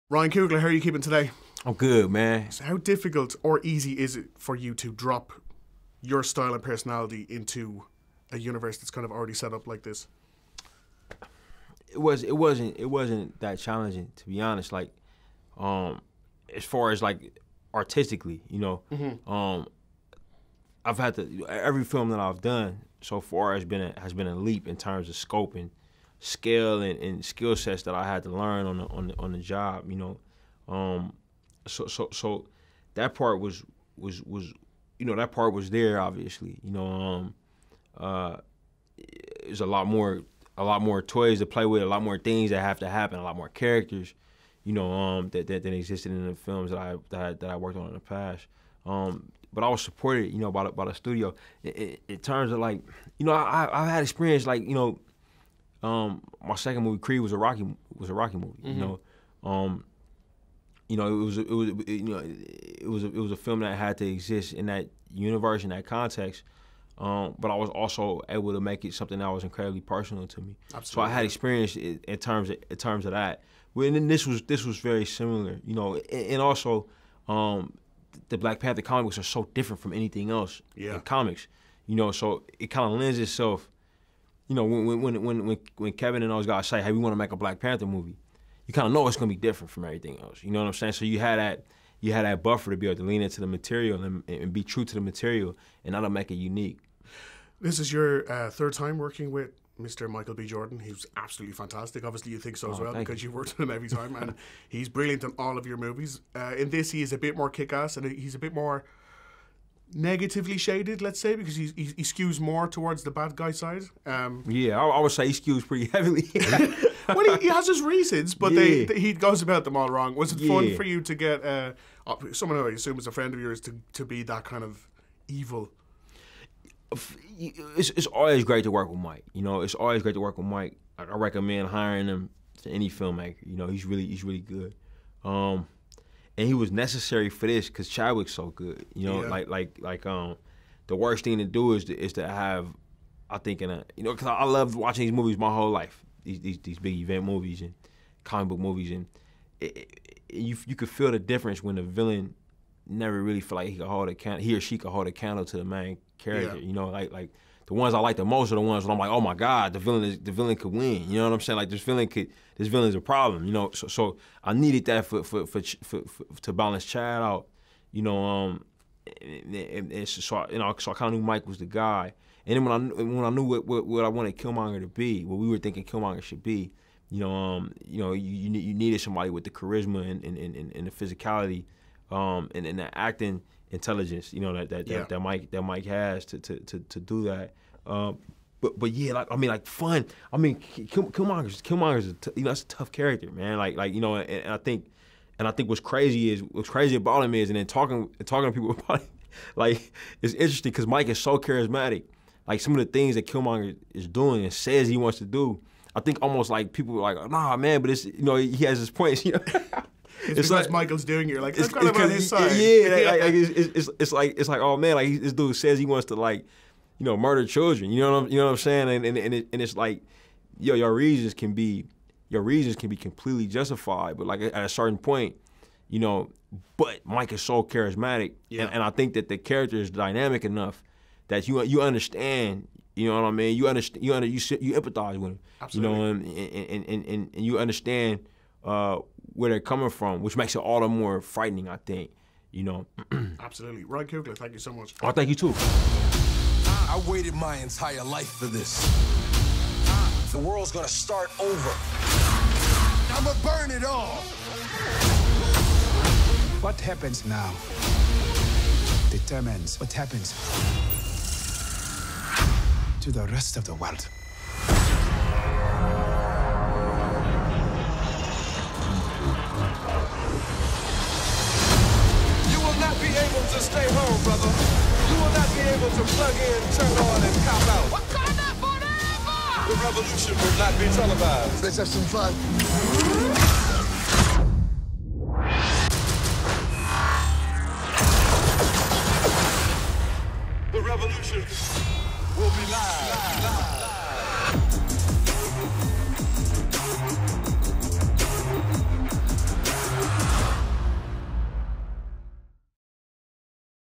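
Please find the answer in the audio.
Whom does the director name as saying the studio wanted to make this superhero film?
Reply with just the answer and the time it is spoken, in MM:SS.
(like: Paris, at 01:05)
Kevin, at 01:25.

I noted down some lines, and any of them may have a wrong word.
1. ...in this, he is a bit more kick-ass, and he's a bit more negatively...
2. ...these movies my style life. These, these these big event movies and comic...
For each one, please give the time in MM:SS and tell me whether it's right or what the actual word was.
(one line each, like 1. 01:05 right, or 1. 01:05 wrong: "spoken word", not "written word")
1. 01:46 right
2. 02:25 wrong: "whole", not "style".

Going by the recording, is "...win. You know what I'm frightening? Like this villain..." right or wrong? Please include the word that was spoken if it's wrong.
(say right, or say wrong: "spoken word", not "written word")
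wrong: "saying", not "frightening".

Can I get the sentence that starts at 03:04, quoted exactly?
that, that, Mike that Mike has to to, to, to do that.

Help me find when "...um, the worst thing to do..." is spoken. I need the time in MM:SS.
02:20.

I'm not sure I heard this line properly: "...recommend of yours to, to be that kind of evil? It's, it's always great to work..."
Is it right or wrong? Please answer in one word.
wrong.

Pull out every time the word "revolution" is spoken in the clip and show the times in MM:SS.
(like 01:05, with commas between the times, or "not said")
04:39, 04:50.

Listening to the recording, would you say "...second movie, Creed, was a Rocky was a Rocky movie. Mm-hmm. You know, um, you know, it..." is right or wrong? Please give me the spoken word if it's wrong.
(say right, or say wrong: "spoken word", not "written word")
right.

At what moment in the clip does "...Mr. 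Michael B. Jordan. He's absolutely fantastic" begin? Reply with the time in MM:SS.
01:39.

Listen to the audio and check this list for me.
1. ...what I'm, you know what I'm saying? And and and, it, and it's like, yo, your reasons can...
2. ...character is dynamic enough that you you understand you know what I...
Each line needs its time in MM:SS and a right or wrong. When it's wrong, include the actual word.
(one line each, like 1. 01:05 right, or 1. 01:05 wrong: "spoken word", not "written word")
1. 03:38 right
2. 03:49 right.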